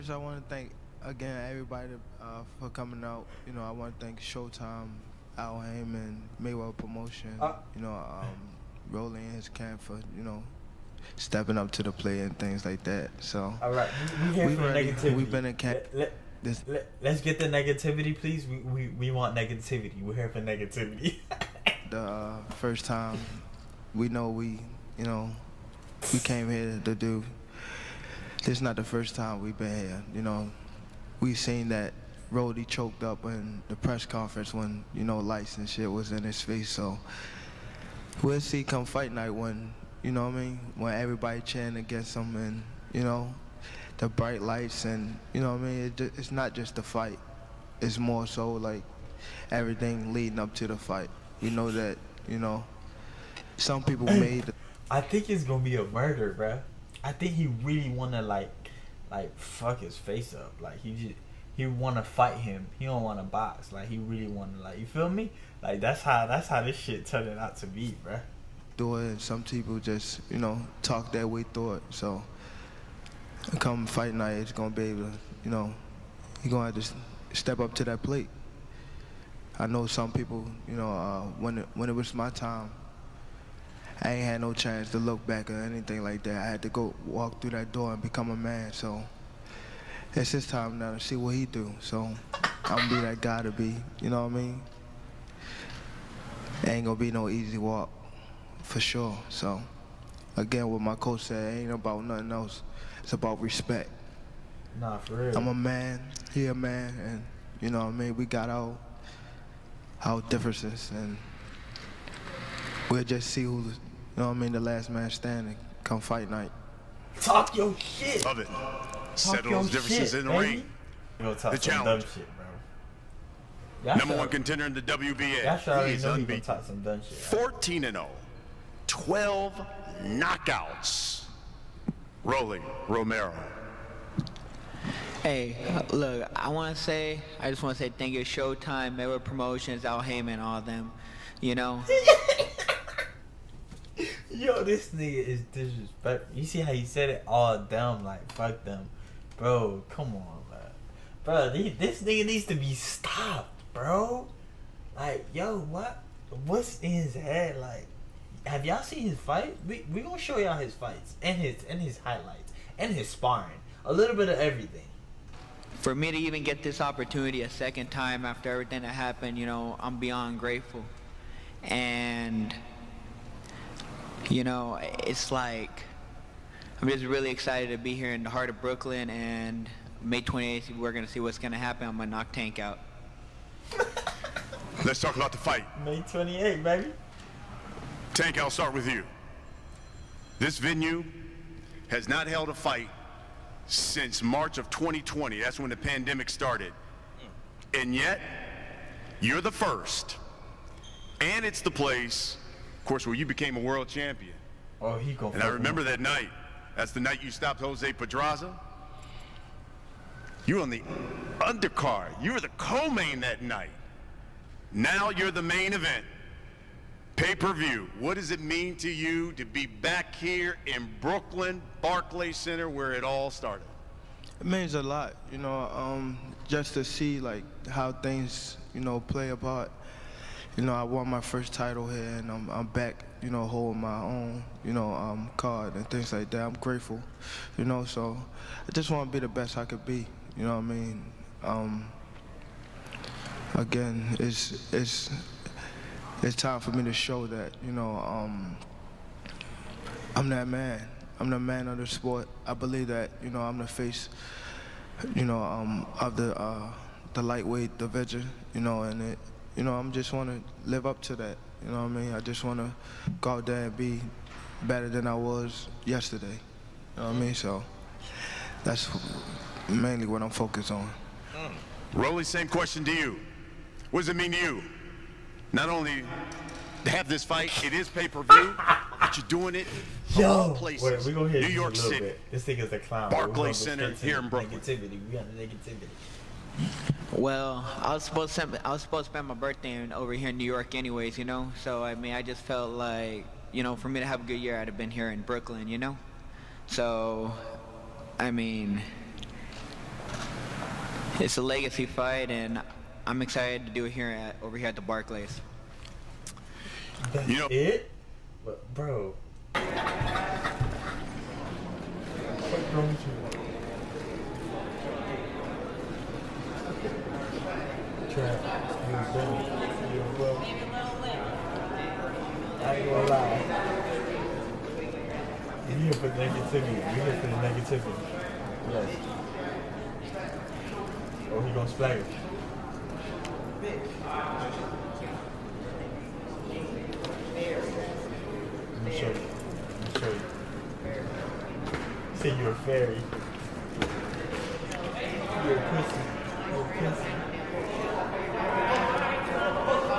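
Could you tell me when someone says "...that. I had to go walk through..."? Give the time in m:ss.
1:26.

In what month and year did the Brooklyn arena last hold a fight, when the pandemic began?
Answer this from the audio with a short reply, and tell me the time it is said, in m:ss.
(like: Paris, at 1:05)
March 2020, at 3:14.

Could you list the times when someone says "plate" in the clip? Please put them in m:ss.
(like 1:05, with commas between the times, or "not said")
0:11, 1:18.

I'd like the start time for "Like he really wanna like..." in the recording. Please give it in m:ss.
1:03.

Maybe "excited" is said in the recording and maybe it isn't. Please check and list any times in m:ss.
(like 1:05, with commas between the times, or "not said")
2:57, 5:03.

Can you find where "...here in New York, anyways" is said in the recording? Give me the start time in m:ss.
4:50.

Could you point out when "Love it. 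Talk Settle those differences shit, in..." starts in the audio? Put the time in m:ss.
1:58.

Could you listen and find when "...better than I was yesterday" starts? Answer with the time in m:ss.
4:24.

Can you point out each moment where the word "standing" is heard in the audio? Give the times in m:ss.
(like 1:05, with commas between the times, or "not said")
1:55.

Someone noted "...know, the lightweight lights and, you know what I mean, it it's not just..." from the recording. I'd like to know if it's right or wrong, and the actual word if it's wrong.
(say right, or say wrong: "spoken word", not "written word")
wrong: "bright", not "lightweight".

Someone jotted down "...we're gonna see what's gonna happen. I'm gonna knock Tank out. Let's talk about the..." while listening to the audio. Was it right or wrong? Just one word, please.
right.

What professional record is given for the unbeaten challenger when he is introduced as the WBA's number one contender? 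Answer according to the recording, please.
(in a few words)
14 and 0.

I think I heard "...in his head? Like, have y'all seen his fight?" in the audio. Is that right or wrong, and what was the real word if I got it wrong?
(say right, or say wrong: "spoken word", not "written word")
right.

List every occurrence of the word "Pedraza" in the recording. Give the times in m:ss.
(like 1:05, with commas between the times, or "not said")
3:27.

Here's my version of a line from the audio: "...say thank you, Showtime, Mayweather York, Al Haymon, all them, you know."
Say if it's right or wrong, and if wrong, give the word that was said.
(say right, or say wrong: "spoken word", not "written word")
wrong: "Promotions", not "York".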